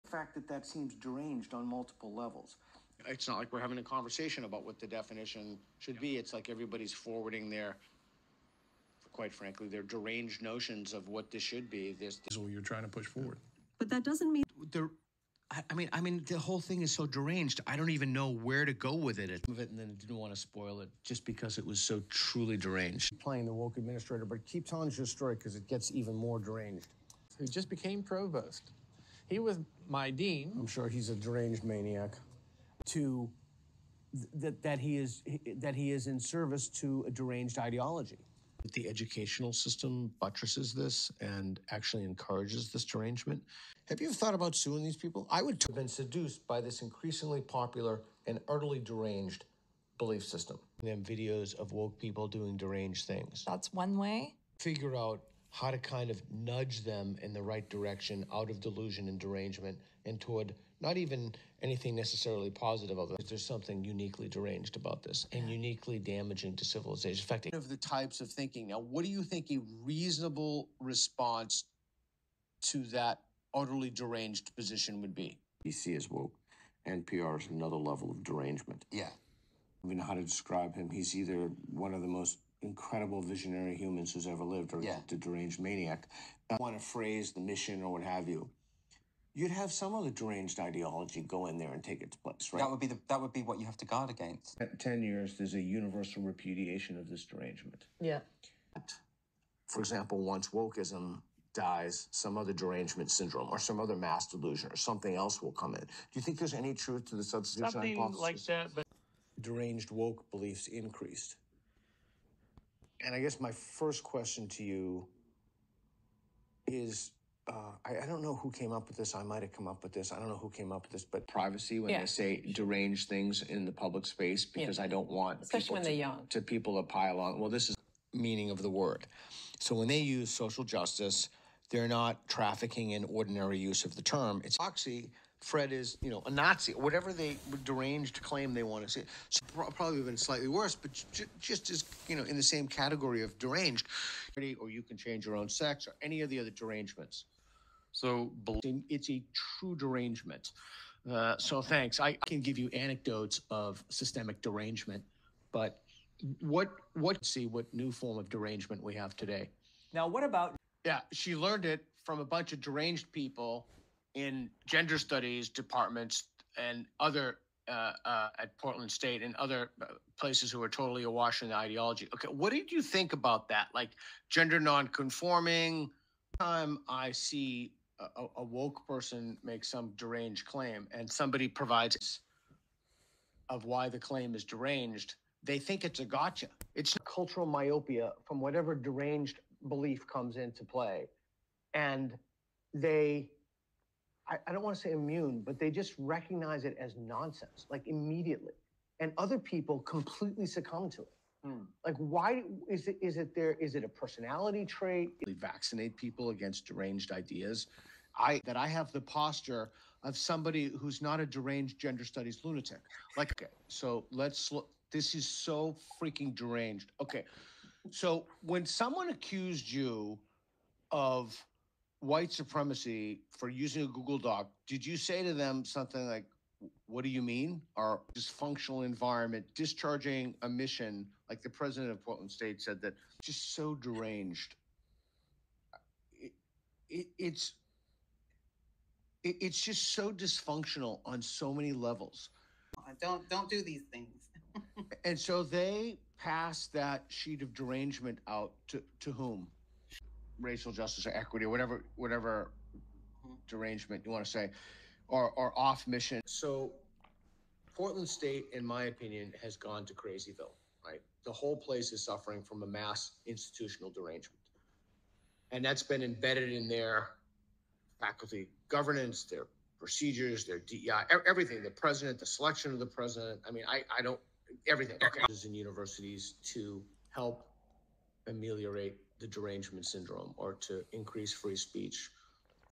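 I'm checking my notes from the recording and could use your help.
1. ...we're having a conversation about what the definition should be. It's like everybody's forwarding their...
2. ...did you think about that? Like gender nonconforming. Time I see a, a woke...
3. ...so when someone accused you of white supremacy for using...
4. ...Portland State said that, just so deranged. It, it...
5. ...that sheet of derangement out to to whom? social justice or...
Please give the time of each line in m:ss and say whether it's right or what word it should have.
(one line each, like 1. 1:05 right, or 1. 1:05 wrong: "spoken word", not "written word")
1. 0:03 right
2. 2:52 right
3. 3:37 right
4. 3:52 right
5. 4:06 wrong: "racial", not "social".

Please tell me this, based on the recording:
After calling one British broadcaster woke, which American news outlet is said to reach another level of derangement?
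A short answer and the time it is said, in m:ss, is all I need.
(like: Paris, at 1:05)
NPR, at 1:16.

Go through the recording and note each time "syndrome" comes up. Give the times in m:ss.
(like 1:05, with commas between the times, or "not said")
1:43, 4:39.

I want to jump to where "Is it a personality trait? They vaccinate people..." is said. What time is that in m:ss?
3:23.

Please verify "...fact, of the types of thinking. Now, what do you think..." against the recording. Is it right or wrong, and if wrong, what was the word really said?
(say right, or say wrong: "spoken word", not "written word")
right.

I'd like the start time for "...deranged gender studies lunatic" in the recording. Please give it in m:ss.
3:31.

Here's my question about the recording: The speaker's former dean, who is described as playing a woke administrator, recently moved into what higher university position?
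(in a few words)
Provost.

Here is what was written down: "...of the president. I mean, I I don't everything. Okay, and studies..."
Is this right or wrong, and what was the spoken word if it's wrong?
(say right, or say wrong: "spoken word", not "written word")
wrong: "universities", not "studies".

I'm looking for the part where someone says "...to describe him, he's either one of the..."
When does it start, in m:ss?
1:20.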